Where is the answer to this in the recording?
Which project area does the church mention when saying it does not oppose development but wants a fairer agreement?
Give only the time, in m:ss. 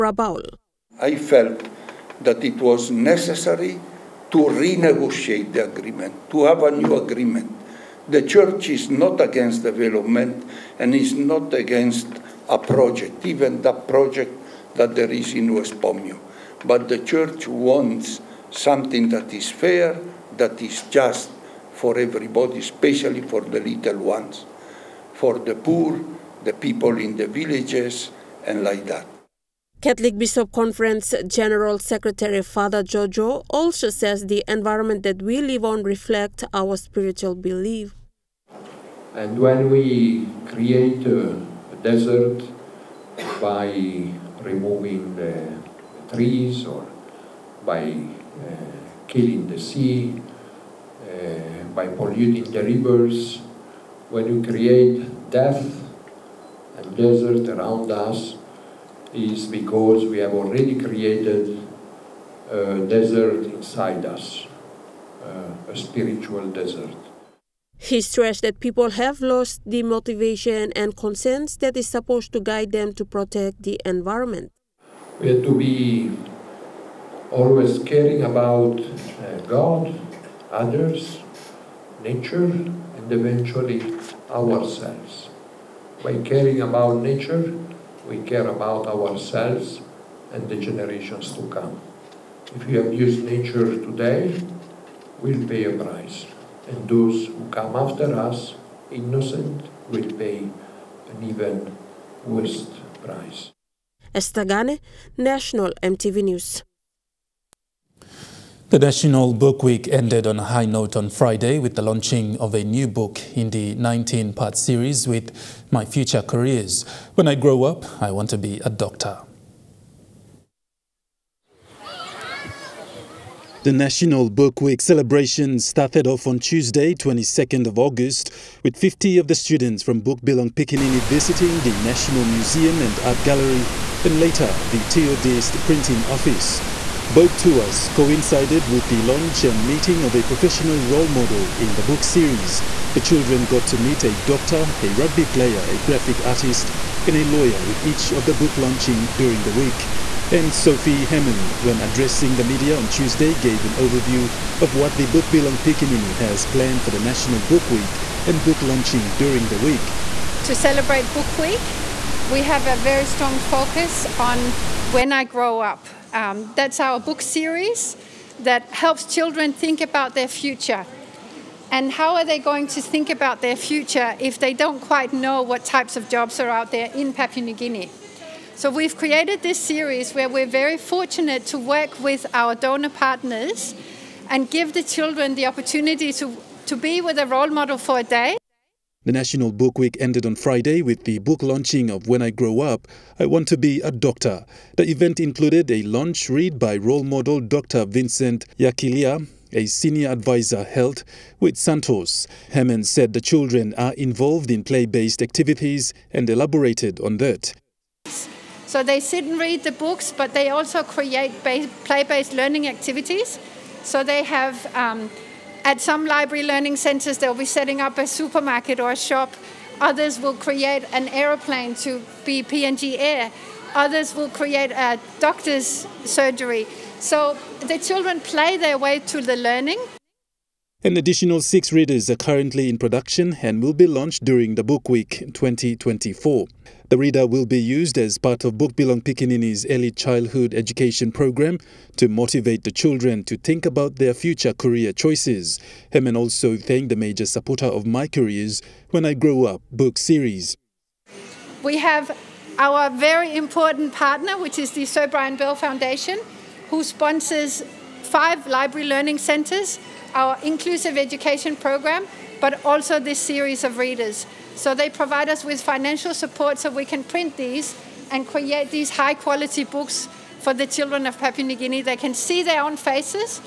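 0:15.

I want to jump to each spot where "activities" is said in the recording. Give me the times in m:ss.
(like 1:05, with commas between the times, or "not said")
3:25, 3:32.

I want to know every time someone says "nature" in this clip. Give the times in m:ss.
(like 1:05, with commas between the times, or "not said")
1:22, 1:27, 1:33.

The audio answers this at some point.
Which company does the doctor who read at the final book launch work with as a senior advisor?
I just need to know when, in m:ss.
3:21.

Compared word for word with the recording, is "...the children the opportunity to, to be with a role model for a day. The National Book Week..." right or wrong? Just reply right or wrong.
right.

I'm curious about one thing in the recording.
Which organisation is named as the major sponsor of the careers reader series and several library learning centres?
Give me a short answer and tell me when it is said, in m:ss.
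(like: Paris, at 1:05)
Sir Brian Bell Foundation, at 4:14.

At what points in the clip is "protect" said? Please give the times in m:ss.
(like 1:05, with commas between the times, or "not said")
1:13.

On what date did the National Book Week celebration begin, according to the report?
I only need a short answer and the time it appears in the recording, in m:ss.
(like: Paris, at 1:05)
22nd of August, at 2:06.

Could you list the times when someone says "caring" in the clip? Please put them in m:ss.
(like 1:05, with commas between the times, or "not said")
1:17, 1:26.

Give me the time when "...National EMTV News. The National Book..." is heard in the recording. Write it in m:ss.
1:45.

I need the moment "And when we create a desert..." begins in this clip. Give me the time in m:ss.
0:39.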